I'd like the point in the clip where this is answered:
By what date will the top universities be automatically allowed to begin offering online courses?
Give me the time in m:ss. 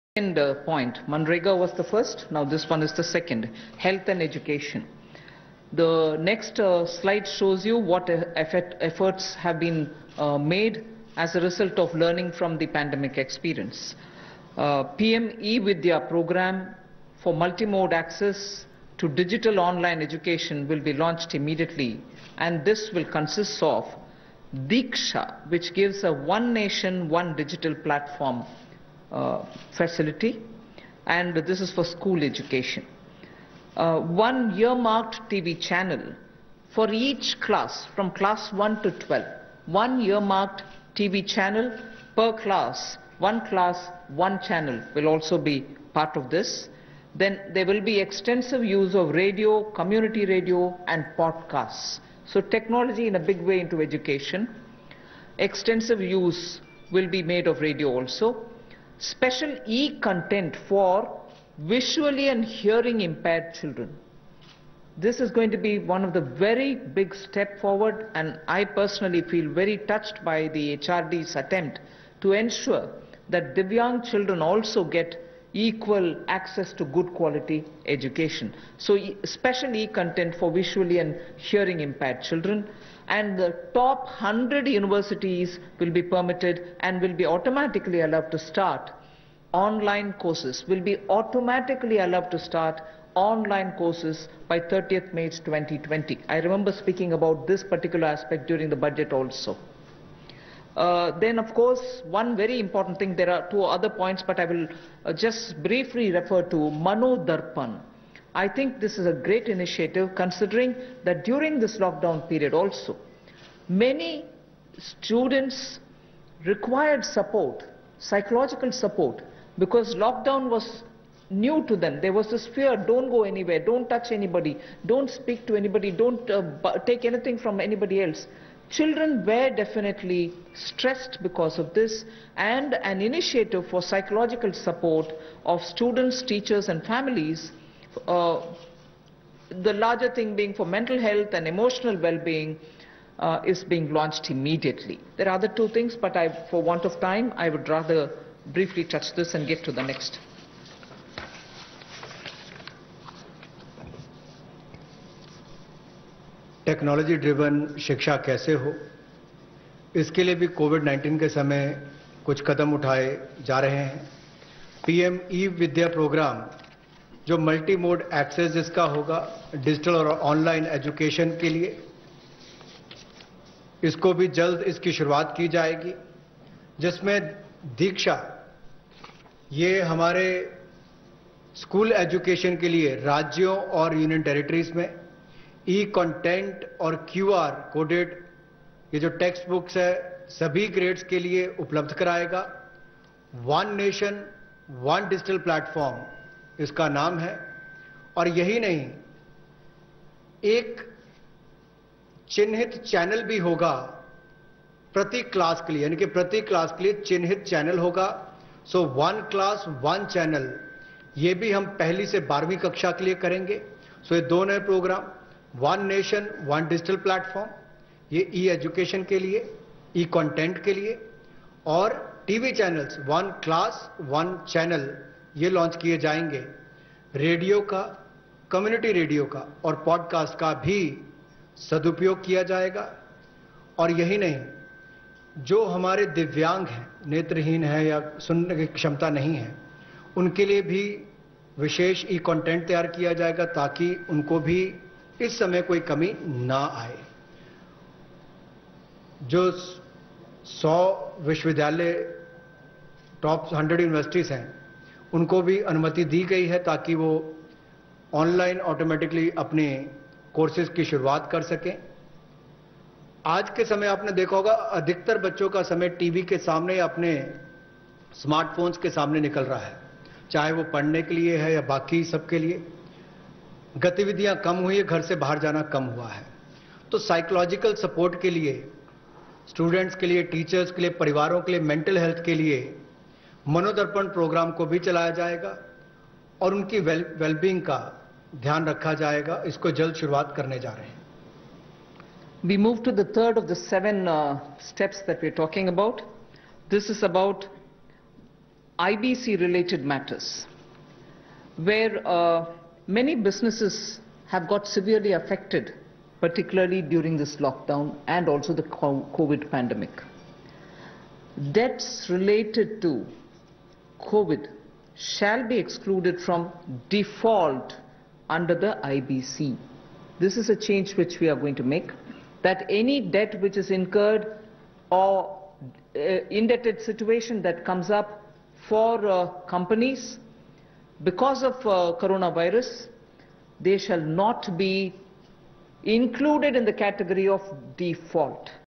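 1:34.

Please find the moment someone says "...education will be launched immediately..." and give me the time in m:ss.
0:20.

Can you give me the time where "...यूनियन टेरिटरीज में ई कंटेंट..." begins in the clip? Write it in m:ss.
3:03.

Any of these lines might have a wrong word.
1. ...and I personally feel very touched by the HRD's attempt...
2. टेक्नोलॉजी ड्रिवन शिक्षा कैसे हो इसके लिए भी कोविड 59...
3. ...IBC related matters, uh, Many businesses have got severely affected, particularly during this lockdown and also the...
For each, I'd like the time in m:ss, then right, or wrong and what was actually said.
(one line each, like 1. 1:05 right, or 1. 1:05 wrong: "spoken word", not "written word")
1. 1:08 right
2. 2:36 wrong: "19", not "59"
3. 4:58 right.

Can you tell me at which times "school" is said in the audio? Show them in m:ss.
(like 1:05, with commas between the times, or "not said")
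0:31.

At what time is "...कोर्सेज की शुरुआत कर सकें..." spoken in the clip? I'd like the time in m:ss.
4:20.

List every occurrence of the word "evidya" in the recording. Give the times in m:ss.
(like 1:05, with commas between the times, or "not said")
0:15.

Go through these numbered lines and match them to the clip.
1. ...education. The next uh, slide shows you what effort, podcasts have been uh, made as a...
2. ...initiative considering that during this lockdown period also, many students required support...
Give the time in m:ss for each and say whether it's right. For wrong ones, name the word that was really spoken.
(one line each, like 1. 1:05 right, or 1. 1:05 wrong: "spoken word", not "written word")
1. 0:04 wrong: "efforts", not "podcasts"
2. 1:49 right.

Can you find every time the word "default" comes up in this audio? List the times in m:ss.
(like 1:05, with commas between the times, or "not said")
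5:16, 5:37.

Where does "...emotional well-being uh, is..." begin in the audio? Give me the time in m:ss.
2:21.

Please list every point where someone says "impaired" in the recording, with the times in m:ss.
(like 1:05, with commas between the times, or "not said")
1:03, 1:21.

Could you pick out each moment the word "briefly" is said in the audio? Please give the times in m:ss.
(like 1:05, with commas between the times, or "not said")
1:45, 2:28.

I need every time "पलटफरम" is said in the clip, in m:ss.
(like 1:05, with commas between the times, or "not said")
3:15, 3:37.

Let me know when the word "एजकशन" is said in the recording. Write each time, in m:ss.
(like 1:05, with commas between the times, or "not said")
2:50, 3:02, 3:38.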